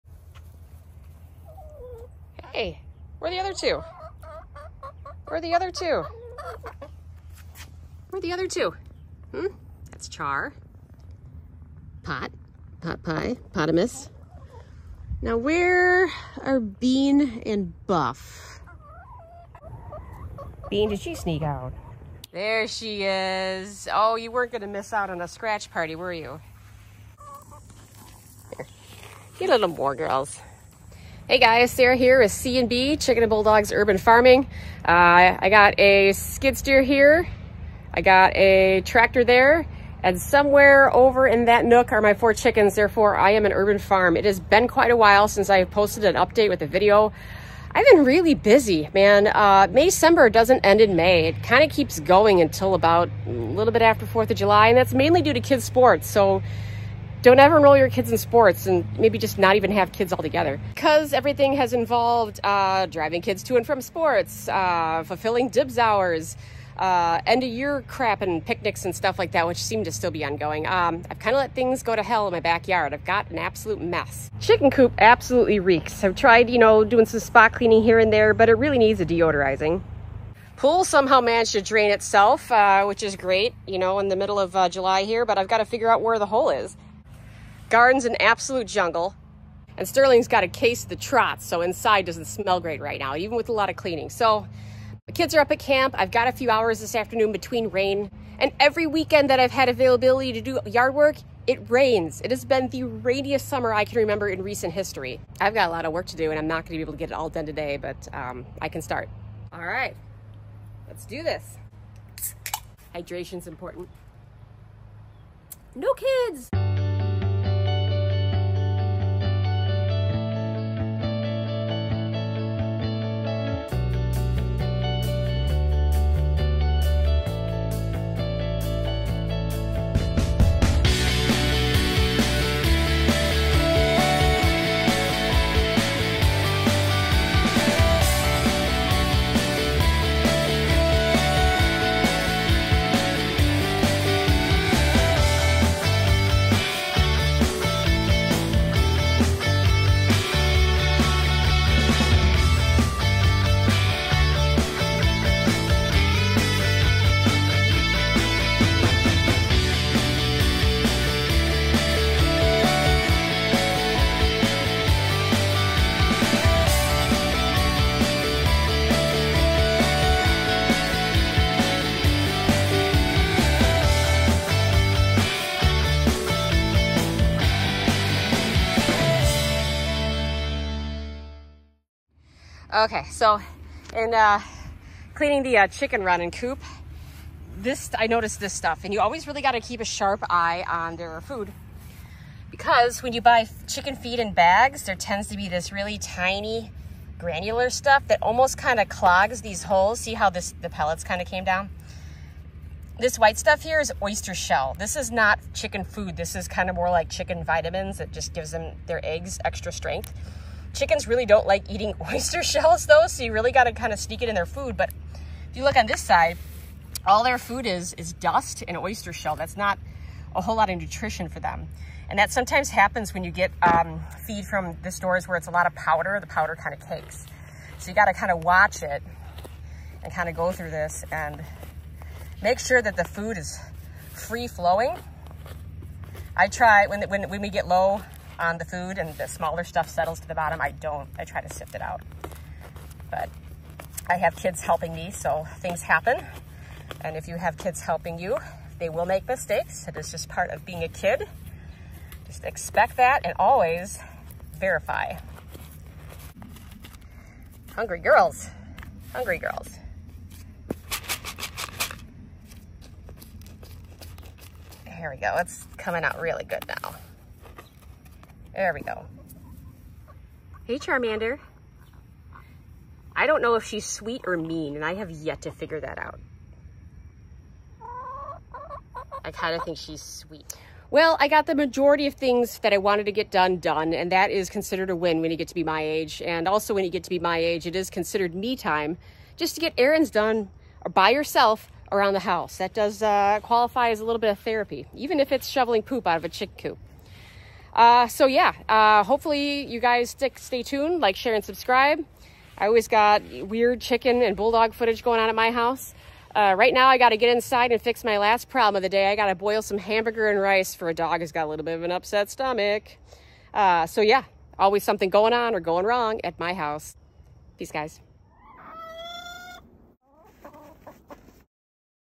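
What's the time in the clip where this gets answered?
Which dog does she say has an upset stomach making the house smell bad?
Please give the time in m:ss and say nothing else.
1:29.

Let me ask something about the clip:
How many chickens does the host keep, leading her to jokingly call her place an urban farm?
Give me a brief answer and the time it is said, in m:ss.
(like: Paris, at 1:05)
4, at 0:42.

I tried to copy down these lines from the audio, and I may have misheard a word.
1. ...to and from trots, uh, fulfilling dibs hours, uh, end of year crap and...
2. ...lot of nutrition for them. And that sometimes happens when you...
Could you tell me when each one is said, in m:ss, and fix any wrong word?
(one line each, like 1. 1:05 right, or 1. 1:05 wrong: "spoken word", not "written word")
1. 1:03 wrong: "sports", not "trots"
2. 3:40 right.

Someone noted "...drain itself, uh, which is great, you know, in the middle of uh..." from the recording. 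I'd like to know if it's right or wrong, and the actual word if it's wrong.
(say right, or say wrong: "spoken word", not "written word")
right.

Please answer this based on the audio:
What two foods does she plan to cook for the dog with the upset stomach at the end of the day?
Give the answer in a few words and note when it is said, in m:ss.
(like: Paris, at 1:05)
hamburger and rice, at 5:09.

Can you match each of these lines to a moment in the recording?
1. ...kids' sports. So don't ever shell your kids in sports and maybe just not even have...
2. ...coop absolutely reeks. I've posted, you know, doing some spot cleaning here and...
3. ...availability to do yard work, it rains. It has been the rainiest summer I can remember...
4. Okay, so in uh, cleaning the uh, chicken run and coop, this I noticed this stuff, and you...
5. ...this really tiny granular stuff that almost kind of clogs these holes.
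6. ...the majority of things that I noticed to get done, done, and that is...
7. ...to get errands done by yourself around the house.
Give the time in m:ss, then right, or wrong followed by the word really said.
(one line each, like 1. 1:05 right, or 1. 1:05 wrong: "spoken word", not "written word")
1. 0:55 wrong: "enroll", not "shell"
2. 1:14 wrong: "tried", not "posted"
3. 1:39 right
4. 3:02 right
5. 3:15 right
6. 4:41 wrong: "wanted", not "noticed"
7. 4:49 right.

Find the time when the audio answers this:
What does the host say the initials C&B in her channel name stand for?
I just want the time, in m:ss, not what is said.
0:32.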